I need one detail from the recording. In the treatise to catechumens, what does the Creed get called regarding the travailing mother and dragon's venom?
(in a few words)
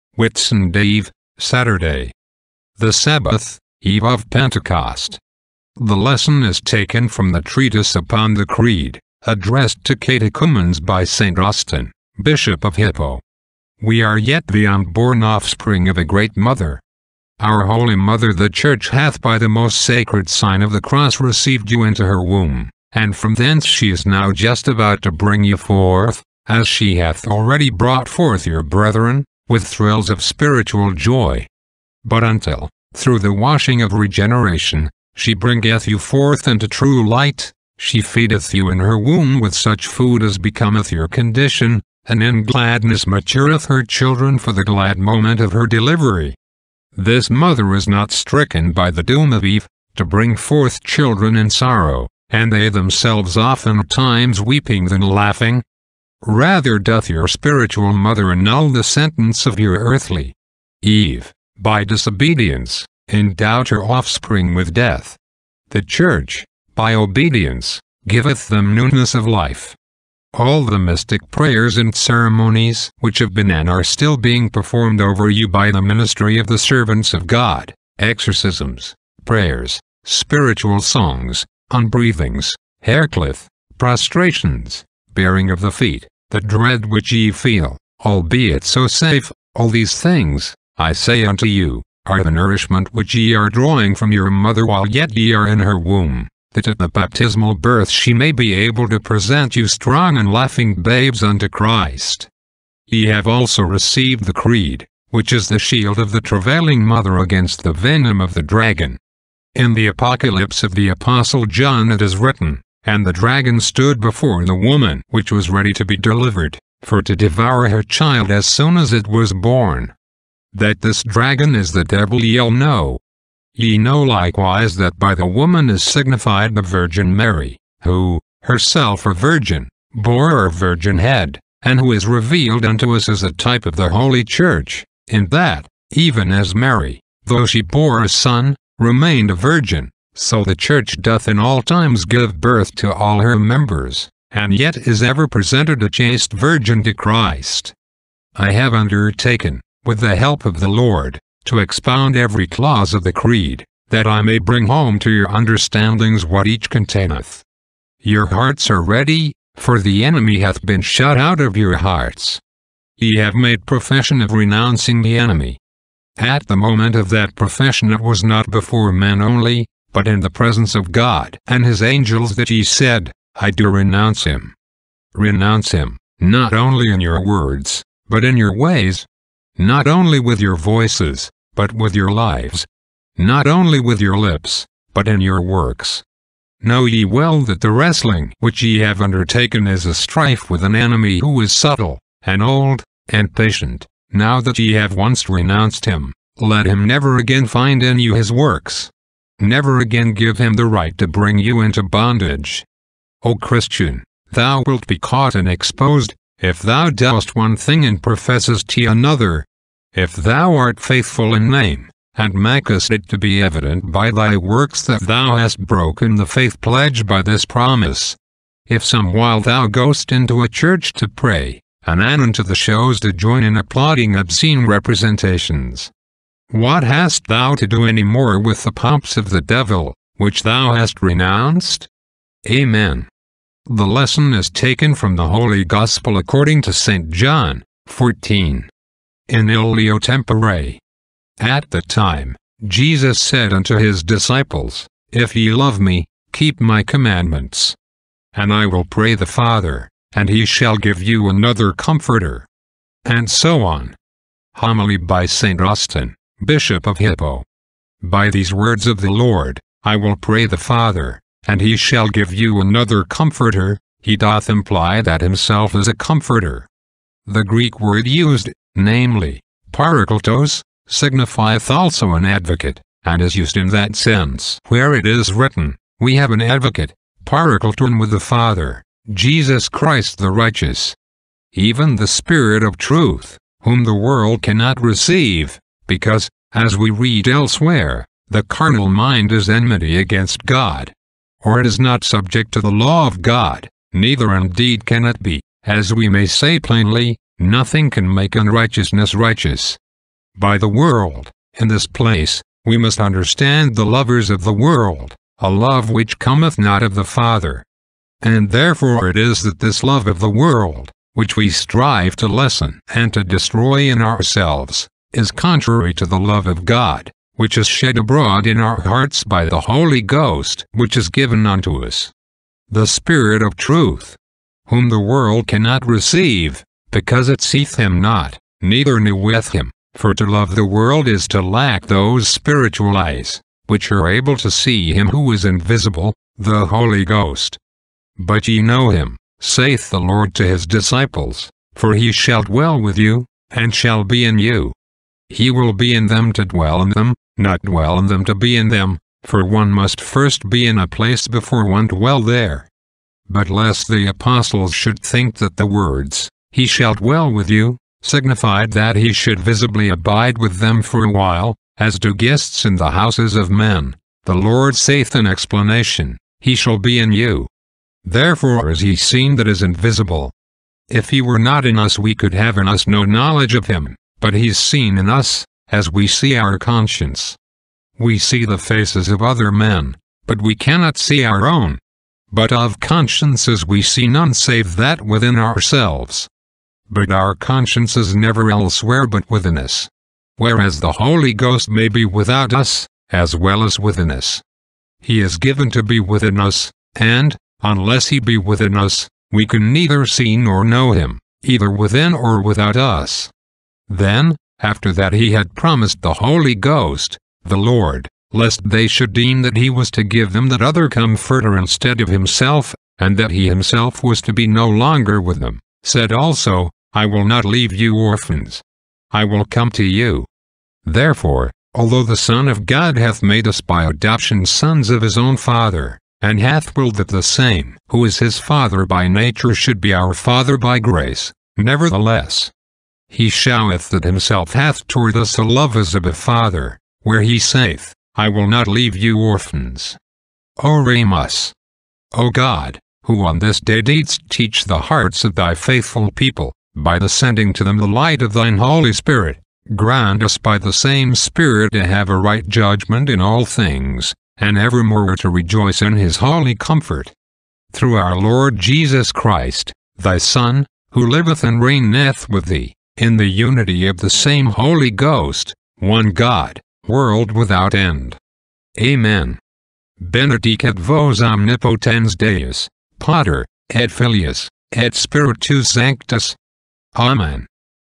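the shield.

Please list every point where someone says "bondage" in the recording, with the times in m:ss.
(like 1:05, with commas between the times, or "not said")
3:21.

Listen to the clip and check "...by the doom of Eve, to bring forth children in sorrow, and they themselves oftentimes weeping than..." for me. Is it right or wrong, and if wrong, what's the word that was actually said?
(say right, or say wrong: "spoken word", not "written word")
right.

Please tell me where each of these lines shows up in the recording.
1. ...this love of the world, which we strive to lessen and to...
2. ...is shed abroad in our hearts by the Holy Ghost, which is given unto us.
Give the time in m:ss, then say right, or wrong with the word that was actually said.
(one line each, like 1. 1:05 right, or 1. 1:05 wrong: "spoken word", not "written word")
1. 5:09 right
2. 5:17 right.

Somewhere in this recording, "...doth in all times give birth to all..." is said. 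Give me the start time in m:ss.
2:20.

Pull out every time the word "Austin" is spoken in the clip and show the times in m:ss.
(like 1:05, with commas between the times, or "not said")
0:11, 4:15.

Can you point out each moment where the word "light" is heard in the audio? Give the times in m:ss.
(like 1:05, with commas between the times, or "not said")
0:37, 7:27.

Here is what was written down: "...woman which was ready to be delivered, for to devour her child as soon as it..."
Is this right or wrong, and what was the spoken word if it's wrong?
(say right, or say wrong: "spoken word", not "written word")
right.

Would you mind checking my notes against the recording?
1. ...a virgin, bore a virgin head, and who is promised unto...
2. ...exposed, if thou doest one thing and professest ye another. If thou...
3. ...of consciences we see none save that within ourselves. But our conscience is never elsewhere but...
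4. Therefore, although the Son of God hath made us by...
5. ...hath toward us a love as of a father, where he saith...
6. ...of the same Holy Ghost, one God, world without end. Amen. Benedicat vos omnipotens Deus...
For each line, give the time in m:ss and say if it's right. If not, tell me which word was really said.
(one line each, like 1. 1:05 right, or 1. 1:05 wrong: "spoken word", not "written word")
1. 2:09 wrong: "revealed", not "promised"
2. 3:25 right
3. 6:22 right
4. 7:00 right
5. 7:14 right
6. 7:43 right.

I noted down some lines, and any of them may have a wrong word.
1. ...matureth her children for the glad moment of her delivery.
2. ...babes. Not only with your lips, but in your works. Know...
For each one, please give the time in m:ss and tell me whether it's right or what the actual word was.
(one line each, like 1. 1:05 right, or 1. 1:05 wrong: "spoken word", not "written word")
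1. 0:43 right
2. 3:02 wrong: "lives", not "babes".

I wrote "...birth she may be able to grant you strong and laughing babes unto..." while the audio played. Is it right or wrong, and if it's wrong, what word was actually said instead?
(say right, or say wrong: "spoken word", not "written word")
wrong: "present", not "grant".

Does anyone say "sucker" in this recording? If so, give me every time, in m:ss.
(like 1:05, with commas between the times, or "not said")
not said.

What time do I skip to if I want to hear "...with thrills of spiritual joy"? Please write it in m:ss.
0:29.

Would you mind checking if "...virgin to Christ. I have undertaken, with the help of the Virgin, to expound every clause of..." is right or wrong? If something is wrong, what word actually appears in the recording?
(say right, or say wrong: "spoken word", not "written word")
wrong: "Lord", not "Virgin".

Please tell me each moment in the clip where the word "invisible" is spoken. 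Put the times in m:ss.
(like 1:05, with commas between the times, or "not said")
5:35, 6:09.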